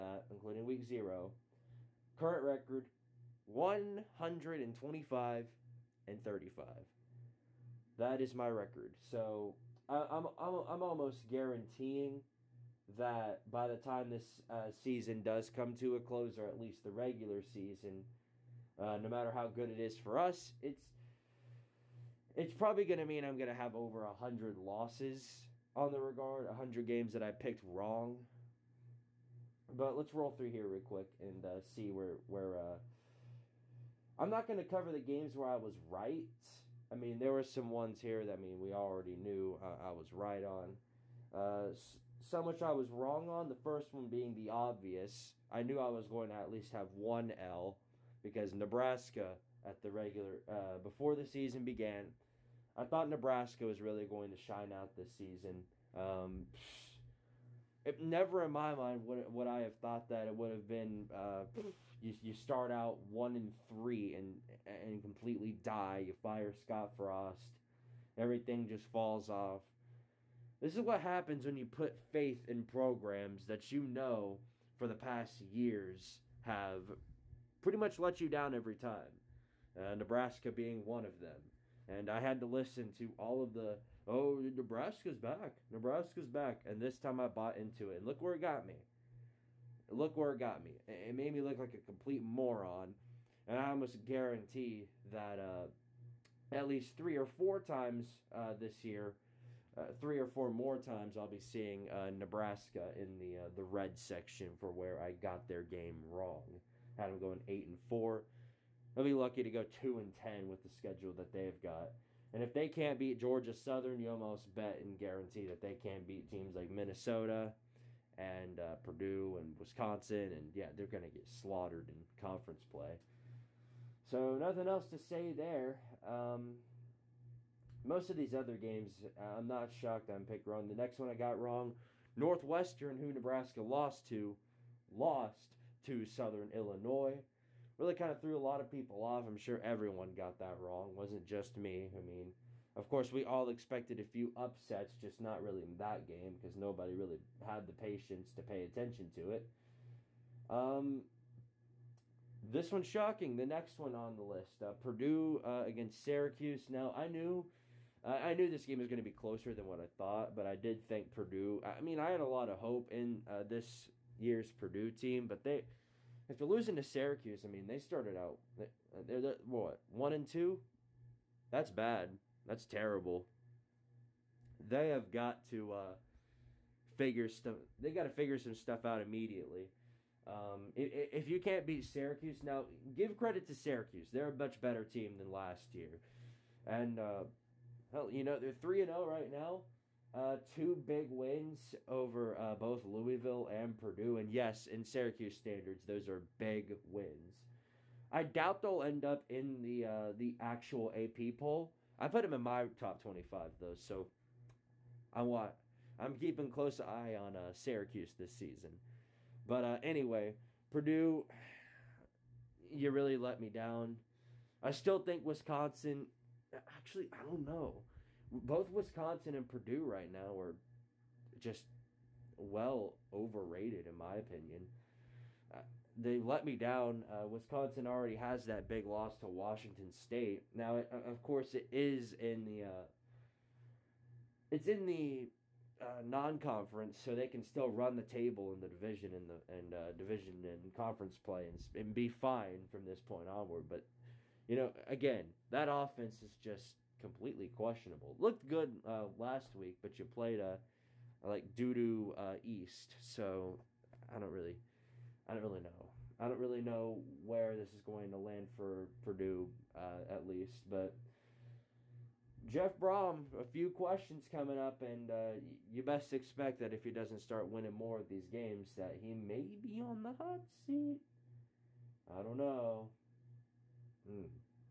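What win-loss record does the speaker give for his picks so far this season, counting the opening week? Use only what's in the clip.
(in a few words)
125-35.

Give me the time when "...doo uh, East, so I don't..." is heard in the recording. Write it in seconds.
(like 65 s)
251 s.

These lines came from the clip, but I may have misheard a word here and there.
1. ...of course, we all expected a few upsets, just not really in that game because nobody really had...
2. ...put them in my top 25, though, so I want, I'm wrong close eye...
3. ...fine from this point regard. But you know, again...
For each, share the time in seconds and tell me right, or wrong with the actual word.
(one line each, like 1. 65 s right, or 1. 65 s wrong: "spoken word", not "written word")
1. 142 s right
2. 202 s wrong: "keeping", not "wrong"
3. 242 s wrong: "onward", not "regard".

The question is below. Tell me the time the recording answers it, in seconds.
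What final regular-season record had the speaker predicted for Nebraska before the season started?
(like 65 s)
107 s.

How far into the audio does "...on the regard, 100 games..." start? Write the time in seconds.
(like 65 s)
25 s.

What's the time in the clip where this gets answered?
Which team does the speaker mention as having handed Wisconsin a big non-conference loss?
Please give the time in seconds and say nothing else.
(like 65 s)
229 s.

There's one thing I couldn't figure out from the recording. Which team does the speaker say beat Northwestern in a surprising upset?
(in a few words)
Southern Illinois.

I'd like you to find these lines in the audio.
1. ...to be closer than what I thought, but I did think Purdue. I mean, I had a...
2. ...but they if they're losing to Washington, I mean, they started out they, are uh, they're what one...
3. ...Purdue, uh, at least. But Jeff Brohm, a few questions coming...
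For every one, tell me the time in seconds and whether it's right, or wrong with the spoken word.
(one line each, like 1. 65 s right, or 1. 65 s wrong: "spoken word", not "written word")
1. 158 s right
2. 165 s wrong: "Syracuse", not "Washington"
3. 259 s right.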